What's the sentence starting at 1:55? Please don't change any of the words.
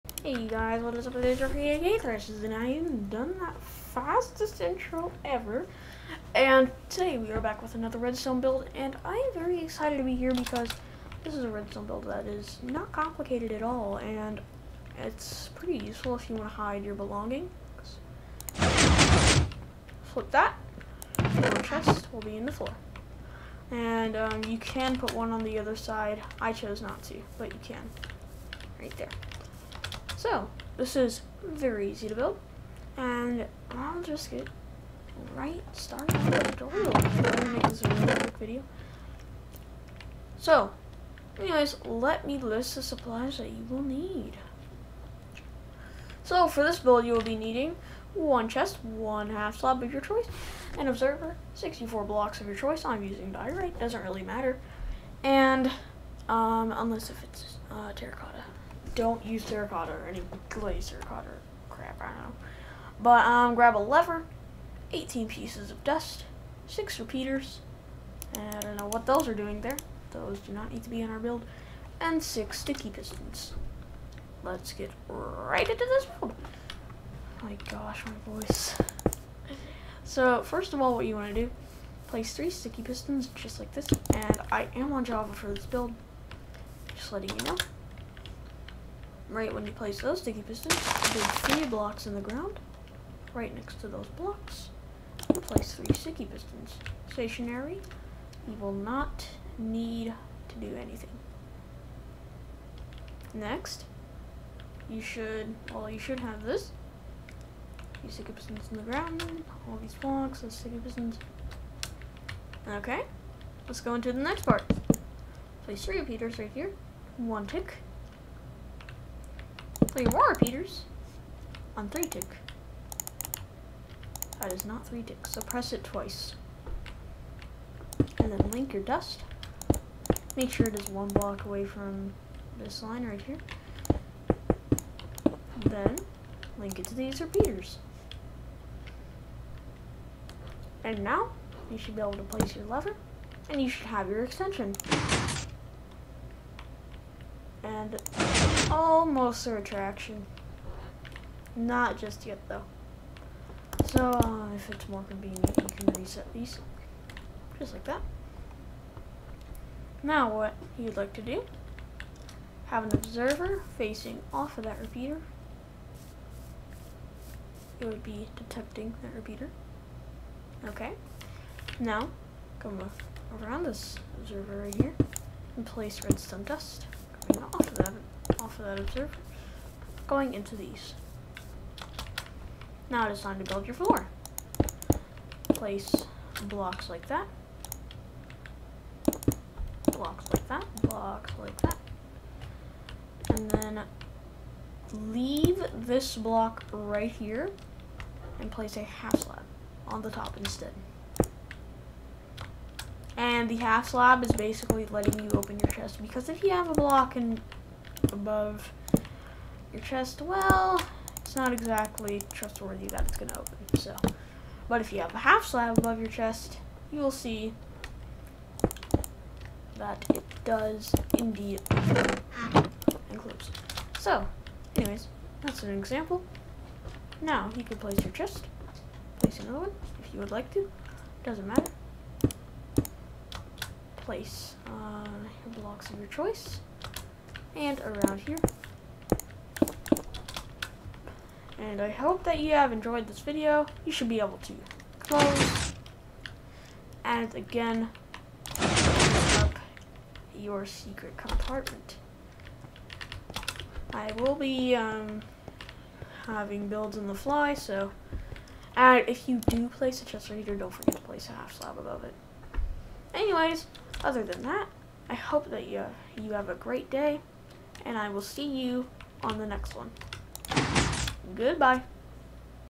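Place three repeaters right here, one tick, three more repeaters on three tick.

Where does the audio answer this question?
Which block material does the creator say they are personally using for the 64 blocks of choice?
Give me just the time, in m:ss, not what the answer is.
0:53.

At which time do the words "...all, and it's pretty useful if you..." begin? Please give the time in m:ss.
0:13.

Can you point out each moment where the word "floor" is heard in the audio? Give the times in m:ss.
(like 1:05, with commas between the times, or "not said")
0:22, 3:03.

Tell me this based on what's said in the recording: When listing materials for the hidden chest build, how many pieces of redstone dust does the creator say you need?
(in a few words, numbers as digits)
18.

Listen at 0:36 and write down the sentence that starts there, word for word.
I'm going to make this a really quick video.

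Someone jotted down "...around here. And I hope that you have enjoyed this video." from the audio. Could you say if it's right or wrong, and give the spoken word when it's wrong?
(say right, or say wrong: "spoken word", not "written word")
right.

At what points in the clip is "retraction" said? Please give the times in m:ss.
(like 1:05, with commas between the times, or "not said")
2:29.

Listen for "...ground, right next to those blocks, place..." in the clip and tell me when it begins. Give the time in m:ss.
1:32.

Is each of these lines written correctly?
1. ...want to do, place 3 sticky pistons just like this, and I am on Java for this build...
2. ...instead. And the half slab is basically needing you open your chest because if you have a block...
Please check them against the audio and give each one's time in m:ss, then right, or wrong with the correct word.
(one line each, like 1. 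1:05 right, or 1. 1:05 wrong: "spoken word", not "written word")
1. 1:21 right
2. 3:20 wrong: "letting", not "needing".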